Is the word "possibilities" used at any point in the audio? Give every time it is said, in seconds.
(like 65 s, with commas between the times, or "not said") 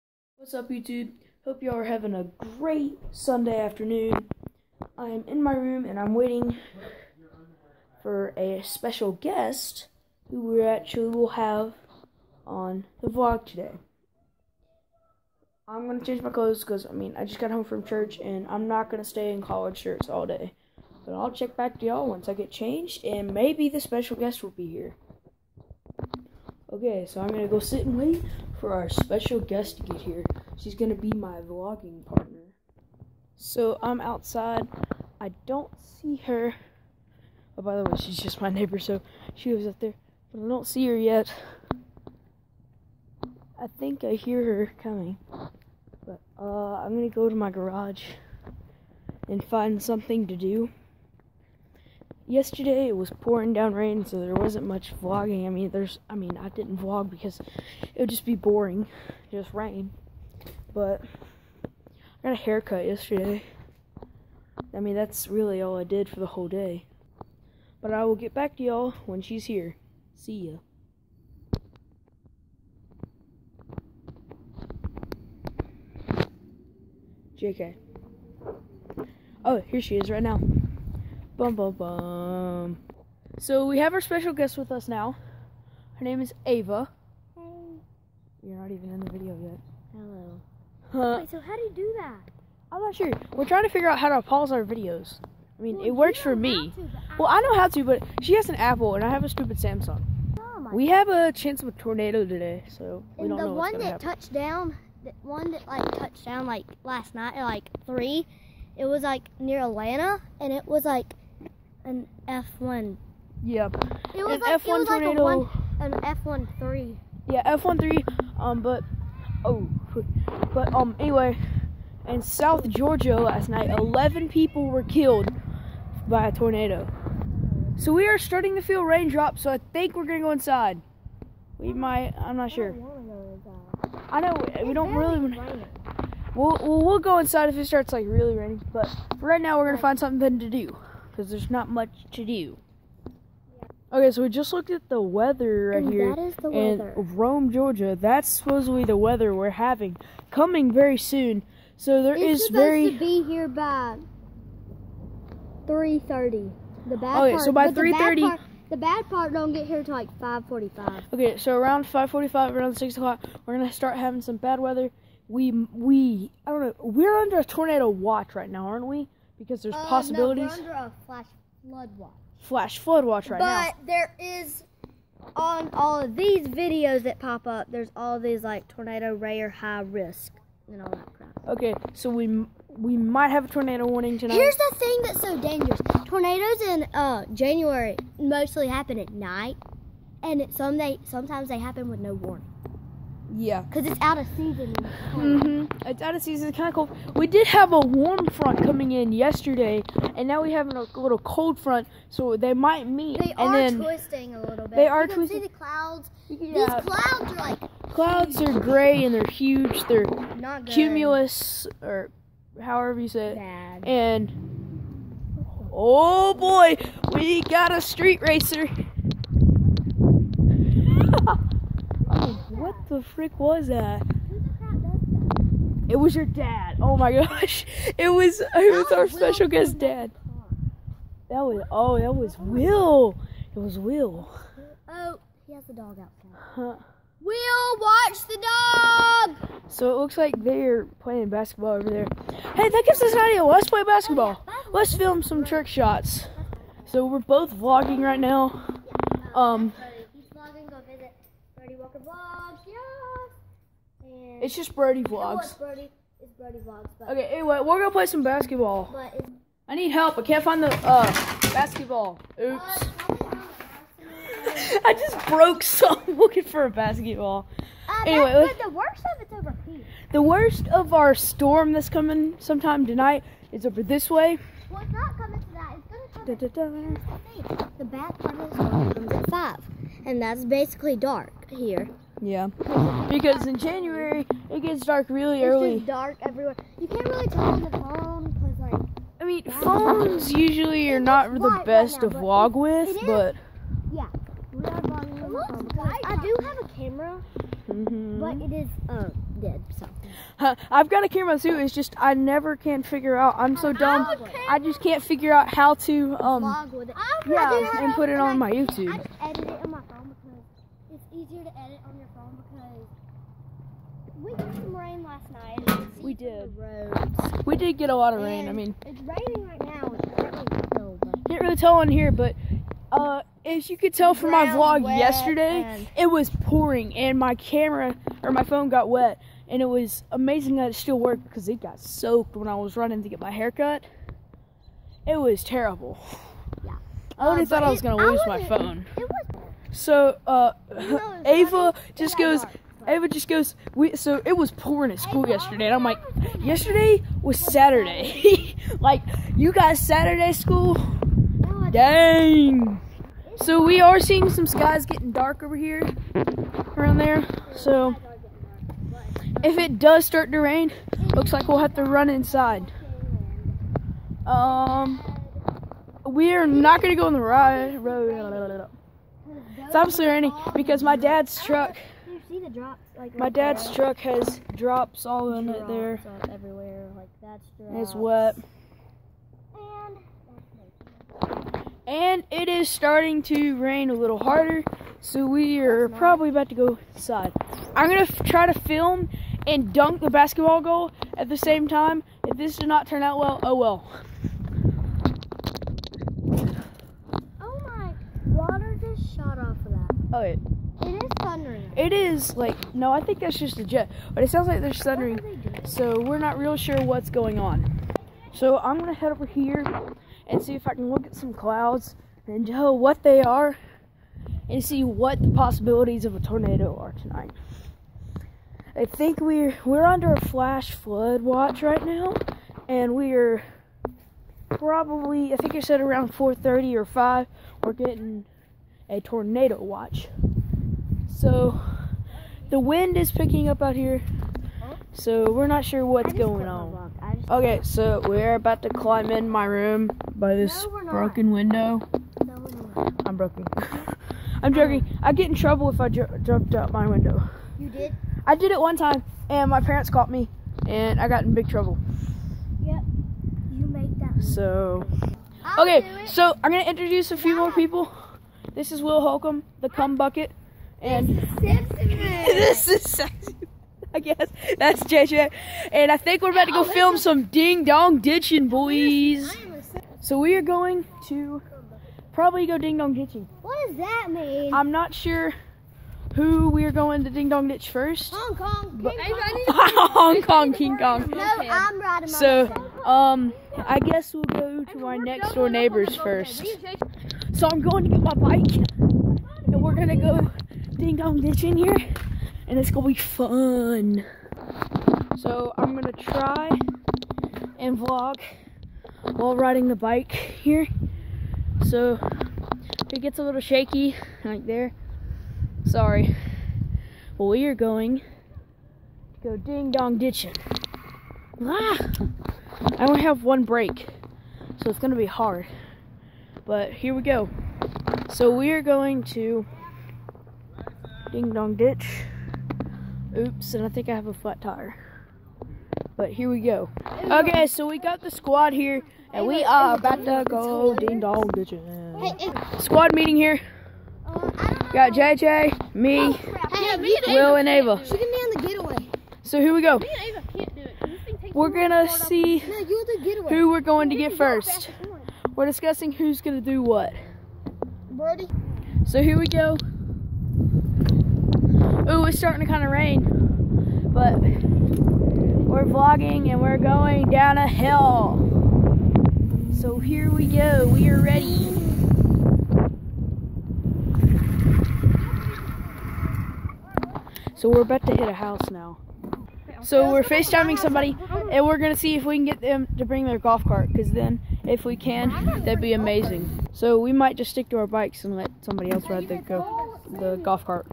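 169 s, 415 s.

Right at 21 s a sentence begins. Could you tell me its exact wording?
But I'll check back to y'all once I get changed and maybe the special guest will be here.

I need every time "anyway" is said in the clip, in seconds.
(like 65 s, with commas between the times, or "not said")
120 s, 257 s, 268 s.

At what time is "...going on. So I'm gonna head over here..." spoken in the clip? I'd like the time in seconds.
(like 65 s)
407 s.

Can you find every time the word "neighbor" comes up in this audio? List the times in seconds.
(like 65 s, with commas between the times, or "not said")
38 s, 485 s.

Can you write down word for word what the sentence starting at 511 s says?
Ah, I only have one brake, so it's gonna be hard.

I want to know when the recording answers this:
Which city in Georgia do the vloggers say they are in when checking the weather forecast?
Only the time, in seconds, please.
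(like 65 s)
147 s.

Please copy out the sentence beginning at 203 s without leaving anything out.
They and are then twisting a little bit.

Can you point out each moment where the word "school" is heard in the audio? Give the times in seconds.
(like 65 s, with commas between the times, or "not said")
344 s, 350 s.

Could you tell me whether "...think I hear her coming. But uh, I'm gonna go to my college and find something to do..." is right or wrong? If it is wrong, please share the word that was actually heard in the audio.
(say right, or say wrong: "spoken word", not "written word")
wrong: "garage", not "college".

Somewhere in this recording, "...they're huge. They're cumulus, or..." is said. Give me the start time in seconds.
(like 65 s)
209 s.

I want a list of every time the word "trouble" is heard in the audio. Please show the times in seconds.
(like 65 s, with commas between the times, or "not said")
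445 s, 451 s.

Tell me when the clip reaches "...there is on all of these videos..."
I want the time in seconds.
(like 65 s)
173 s.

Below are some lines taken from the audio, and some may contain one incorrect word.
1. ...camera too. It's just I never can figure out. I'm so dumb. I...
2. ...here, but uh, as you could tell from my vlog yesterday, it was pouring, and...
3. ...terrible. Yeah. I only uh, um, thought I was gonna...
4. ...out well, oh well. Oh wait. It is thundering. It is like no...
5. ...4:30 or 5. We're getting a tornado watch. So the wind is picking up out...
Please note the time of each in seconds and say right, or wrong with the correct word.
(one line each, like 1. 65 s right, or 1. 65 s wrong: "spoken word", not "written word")
1. 301 s right
2. 321 s right
3. 335 s right
4. 393 s right
5. 426 s right.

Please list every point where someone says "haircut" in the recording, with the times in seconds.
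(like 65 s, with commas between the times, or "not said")
62 s, 333 s.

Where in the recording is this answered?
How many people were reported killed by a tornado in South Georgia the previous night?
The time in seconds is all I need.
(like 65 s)
123 s.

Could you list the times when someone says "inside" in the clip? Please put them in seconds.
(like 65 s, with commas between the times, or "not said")
130 s, 137 s, 362 s, 386 s.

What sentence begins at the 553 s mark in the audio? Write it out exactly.
But we're vlogging and we're going down a hill.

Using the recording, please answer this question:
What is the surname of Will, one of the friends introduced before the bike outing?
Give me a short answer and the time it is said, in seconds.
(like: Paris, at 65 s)
Holcomb, at 458 s.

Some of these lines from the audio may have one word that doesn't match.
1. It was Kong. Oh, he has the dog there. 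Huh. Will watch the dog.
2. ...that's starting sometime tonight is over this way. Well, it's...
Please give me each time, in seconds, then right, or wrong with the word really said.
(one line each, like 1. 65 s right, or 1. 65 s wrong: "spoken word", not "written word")
1. 233 s wrong: "Will", not "Kong"
2. 271 s wrong: "coming", not "starting".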